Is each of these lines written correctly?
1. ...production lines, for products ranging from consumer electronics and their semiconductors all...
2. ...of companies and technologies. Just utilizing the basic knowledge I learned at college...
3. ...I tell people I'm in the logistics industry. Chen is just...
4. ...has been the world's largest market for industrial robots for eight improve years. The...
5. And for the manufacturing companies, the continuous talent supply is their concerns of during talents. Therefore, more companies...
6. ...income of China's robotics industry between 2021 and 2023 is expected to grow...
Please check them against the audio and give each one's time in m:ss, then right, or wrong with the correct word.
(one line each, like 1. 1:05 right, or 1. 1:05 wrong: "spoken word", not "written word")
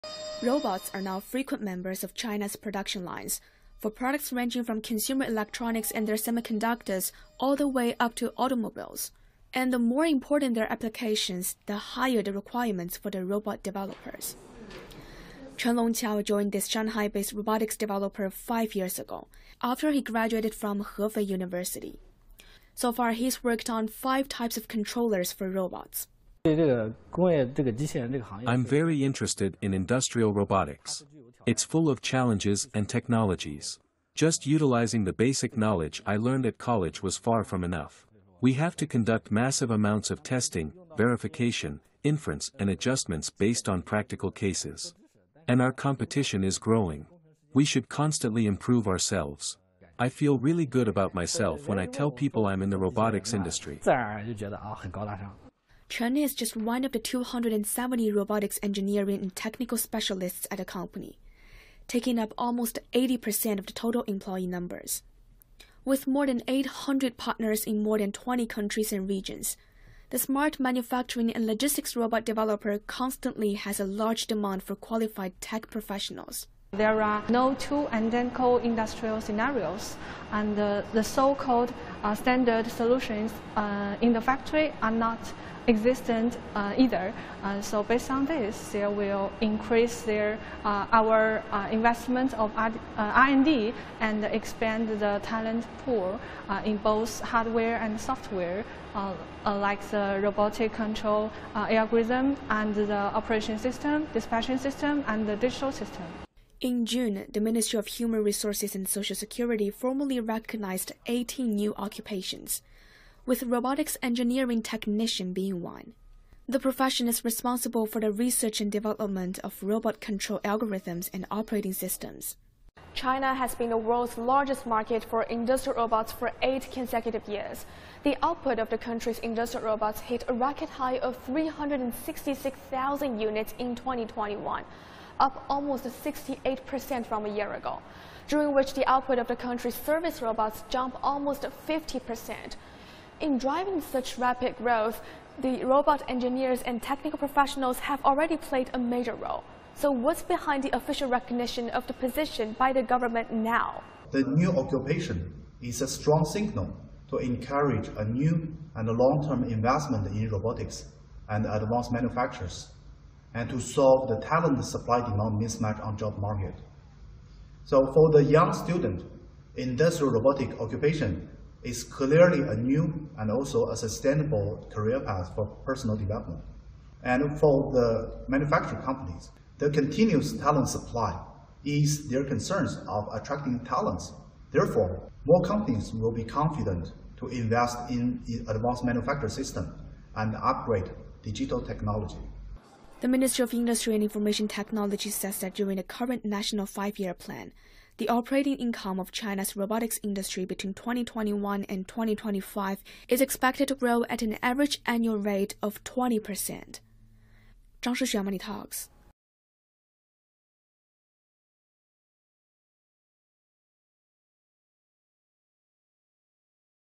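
1. 0:02 right
2. 0:31 wrong: "challenges", not "companies"
3. 0:51 wrong: "robotics", not "logistics"
4. 2:03 wrong: "consecutive", not "improve"
5. 2:57 wrong: "attracting", not "during"
6. 3:18 wrong: "2025", not "2023".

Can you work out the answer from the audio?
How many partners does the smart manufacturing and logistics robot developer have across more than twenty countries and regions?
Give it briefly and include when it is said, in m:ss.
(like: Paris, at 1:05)
more than 800, at 1:06.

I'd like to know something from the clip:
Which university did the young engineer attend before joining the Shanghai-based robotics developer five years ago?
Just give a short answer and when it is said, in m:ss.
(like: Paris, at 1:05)
Hefei University, at 0:20.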